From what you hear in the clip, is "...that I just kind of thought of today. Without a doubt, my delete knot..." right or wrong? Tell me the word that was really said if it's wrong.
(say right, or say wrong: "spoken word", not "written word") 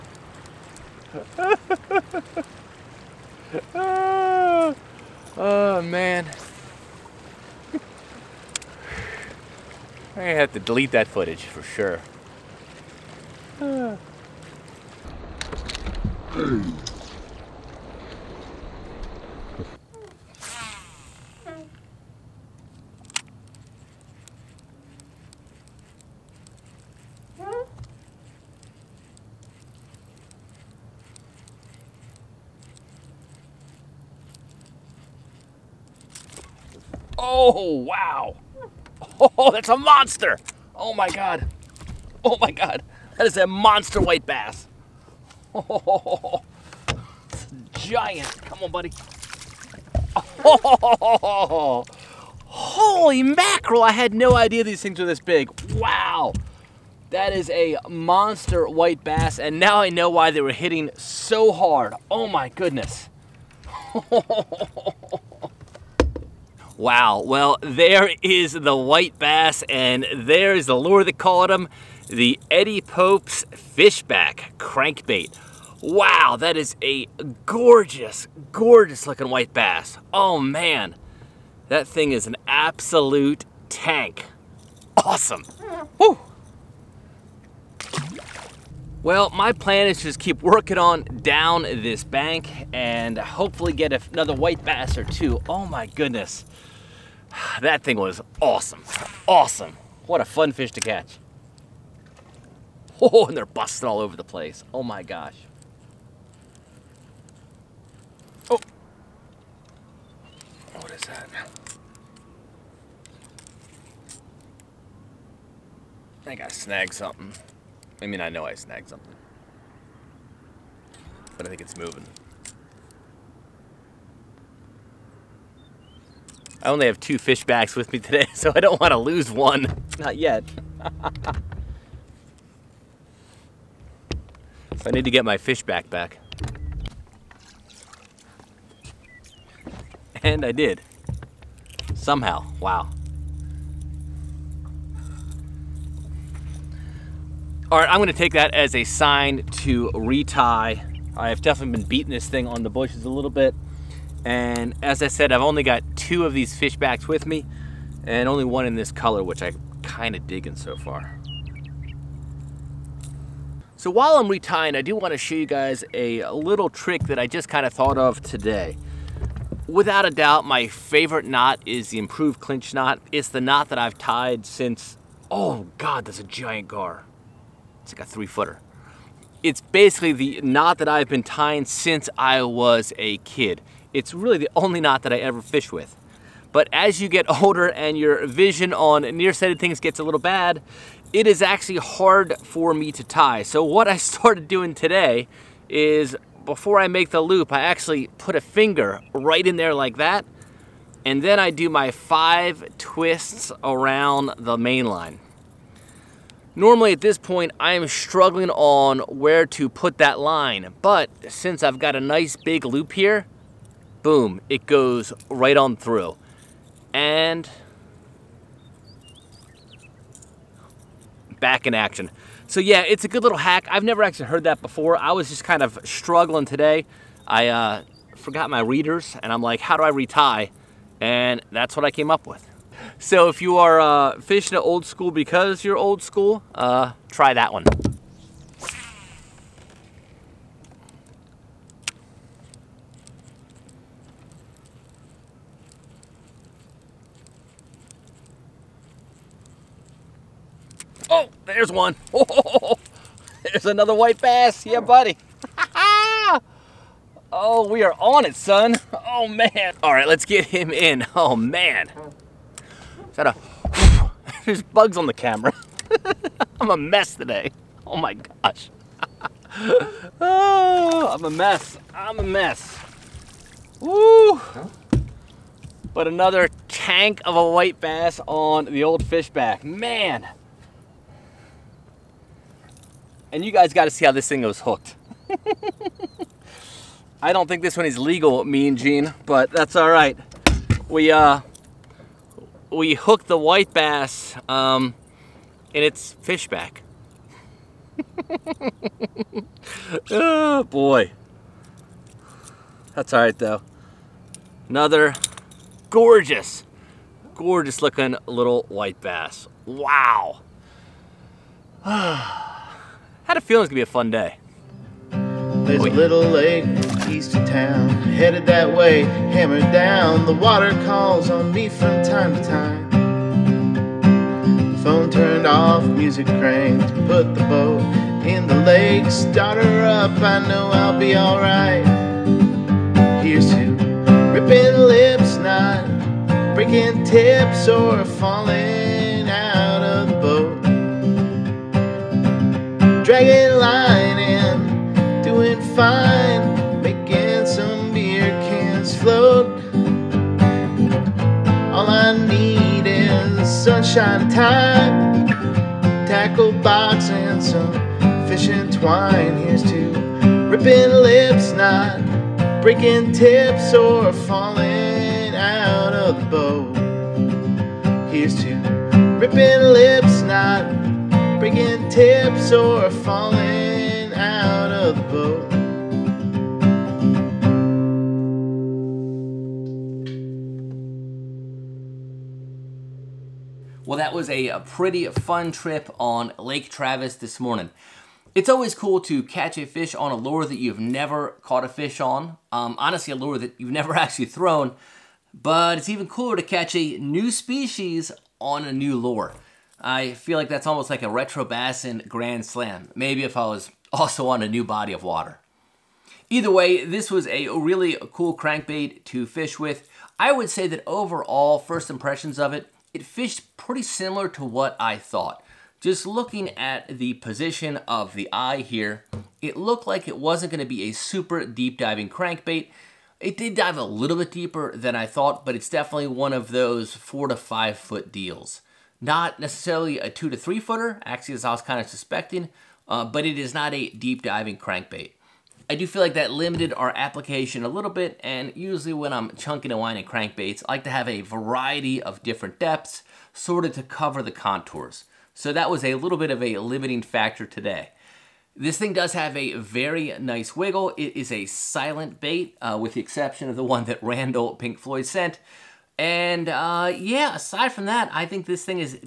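wrong: "favorite", not "delete".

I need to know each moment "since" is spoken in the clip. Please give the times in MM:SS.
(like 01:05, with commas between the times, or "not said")
02:54, 03:01, 03:31.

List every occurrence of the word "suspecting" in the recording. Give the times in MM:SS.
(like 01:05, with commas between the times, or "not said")
07:11.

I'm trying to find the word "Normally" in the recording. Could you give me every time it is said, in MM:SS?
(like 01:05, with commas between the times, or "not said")
03:26.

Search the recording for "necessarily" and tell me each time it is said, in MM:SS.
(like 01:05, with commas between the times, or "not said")
07:09.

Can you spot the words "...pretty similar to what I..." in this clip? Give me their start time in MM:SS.
06:53.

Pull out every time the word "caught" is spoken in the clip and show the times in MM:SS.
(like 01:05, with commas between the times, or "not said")
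01:11, 06:31.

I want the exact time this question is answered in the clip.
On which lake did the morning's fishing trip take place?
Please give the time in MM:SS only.
06:26.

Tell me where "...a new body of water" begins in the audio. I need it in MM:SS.
06:44.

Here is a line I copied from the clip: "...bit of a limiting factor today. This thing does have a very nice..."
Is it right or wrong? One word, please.
right.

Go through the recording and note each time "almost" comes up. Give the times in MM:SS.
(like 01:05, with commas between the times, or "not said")
06:40.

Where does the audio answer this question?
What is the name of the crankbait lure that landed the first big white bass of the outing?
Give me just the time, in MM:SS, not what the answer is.
01:12.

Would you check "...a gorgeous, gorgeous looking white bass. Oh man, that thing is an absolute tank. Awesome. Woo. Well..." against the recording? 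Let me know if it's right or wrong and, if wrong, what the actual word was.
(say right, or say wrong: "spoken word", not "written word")
right.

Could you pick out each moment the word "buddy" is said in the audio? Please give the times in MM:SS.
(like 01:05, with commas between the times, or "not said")
00:48, 04:14.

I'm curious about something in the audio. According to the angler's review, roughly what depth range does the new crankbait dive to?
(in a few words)
4 to 5 feet.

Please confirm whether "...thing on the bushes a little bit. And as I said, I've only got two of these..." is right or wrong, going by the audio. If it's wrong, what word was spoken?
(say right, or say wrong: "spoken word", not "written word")
right.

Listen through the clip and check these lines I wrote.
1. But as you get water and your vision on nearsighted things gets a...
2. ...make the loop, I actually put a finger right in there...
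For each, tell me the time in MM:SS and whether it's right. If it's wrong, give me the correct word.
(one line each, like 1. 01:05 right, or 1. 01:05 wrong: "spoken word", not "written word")
1. 03:06 wrong: "older", not "water"
2. 03:16 right.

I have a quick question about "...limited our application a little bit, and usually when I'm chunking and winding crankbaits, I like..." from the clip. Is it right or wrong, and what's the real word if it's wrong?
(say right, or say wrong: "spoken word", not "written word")
right.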